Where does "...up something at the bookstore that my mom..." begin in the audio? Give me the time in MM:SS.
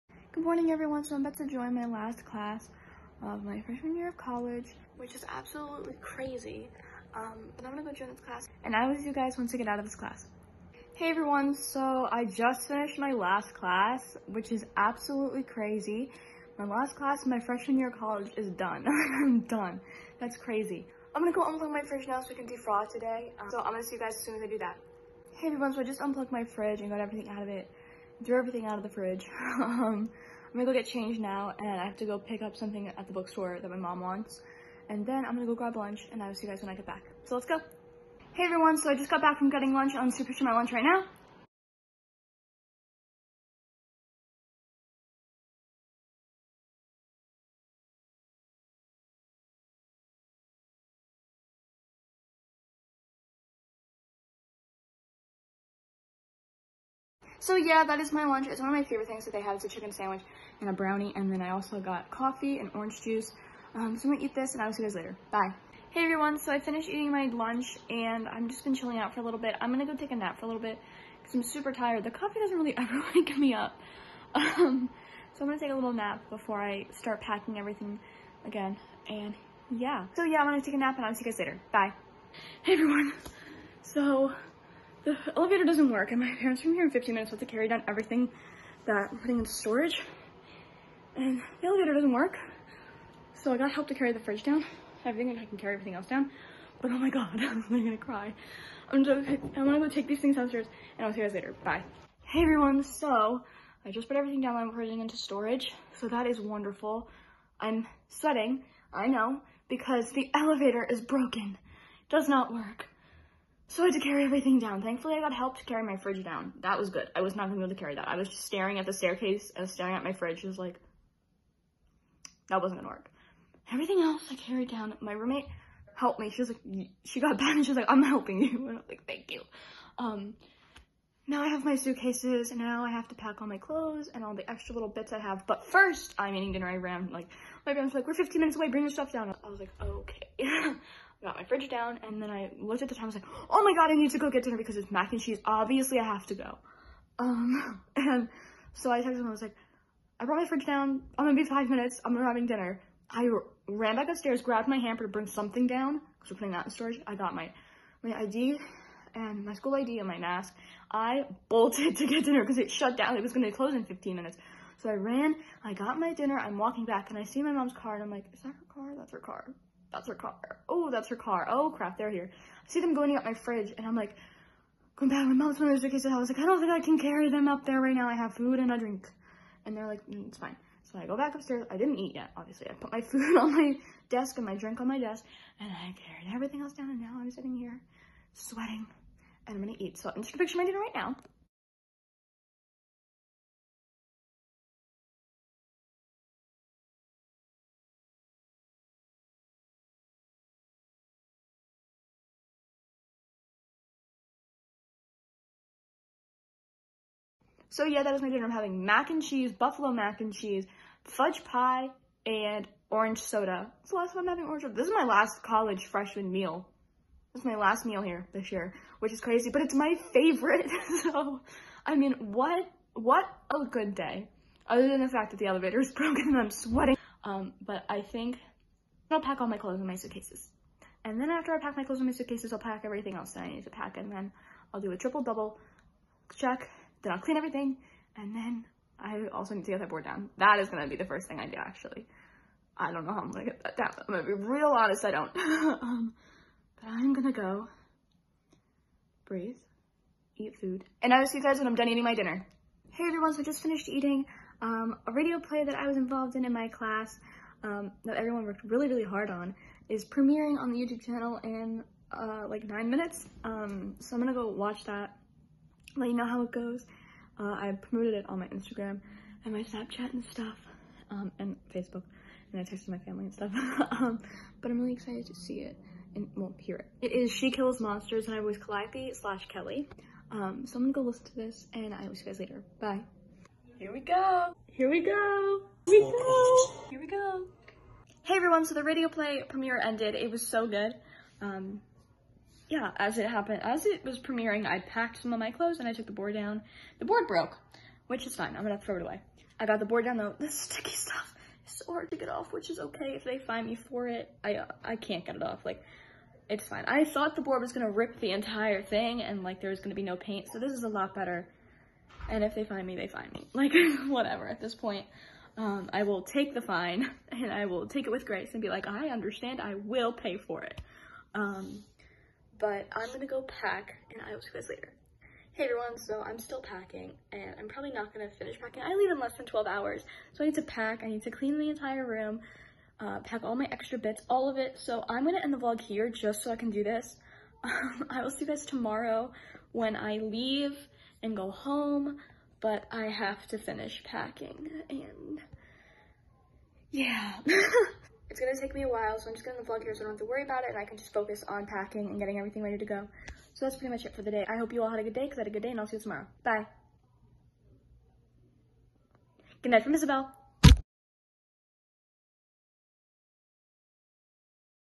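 00:32.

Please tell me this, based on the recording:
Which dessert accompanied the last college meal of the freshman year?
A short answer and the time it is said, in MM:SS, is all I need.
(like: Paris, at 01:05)
fudge pie, at 03:31.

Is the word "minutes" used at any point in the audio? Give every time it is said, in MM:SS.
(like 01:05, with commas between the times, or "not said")
01:27, 02:18, 02:31, 02:44, 04:22.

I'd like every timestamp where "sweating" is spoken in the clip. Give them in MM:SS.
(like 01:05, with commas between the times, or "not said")
01:48, 03:08, 03:46.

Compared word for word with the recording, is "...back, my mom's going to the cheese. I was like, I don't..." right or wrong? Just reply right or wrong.
wrong.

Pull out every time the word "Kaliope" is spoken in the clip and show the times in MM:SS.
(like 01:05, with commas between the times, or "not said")
04:38.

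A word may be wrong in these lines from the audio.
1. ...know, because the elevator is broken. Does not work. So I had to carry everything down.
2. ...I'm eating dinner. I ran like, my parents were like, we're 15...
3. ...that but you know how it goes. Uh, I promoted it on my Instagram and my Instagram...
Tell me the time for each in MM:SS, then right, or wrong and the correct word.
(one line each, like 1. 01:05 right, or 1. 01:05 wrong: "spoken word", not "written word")
1. 01:49 right
2. 02:16 right
3. 04:24 wrong: "Snapchat", not "Instagram".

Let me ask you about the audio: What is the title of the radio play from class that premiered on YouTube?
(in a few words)
She Kills Monsters.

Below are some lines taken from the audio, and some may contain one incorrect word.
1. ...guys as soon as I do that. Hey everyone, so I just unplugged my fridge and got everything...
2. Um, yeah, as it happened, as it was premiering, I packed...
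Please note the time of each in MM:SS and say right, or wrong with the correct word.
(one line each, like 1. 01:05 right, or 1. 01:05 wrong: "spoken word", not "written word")
1. 00:24 right
2. 04:51 right.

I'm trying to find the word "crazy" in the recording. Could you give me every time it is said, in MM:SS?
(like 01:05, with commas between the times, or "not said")
00:05, 00:15, 00:20, 03:39.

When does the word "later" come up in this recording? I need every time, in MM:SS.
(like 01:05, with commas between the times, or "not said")
01:04, 01:21, 01:41, 04:42, 05:24.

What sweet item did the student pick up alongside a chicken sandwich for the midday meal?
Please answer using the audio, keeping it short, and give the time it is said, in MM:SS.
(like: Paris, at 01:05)
brownie, at 01:00.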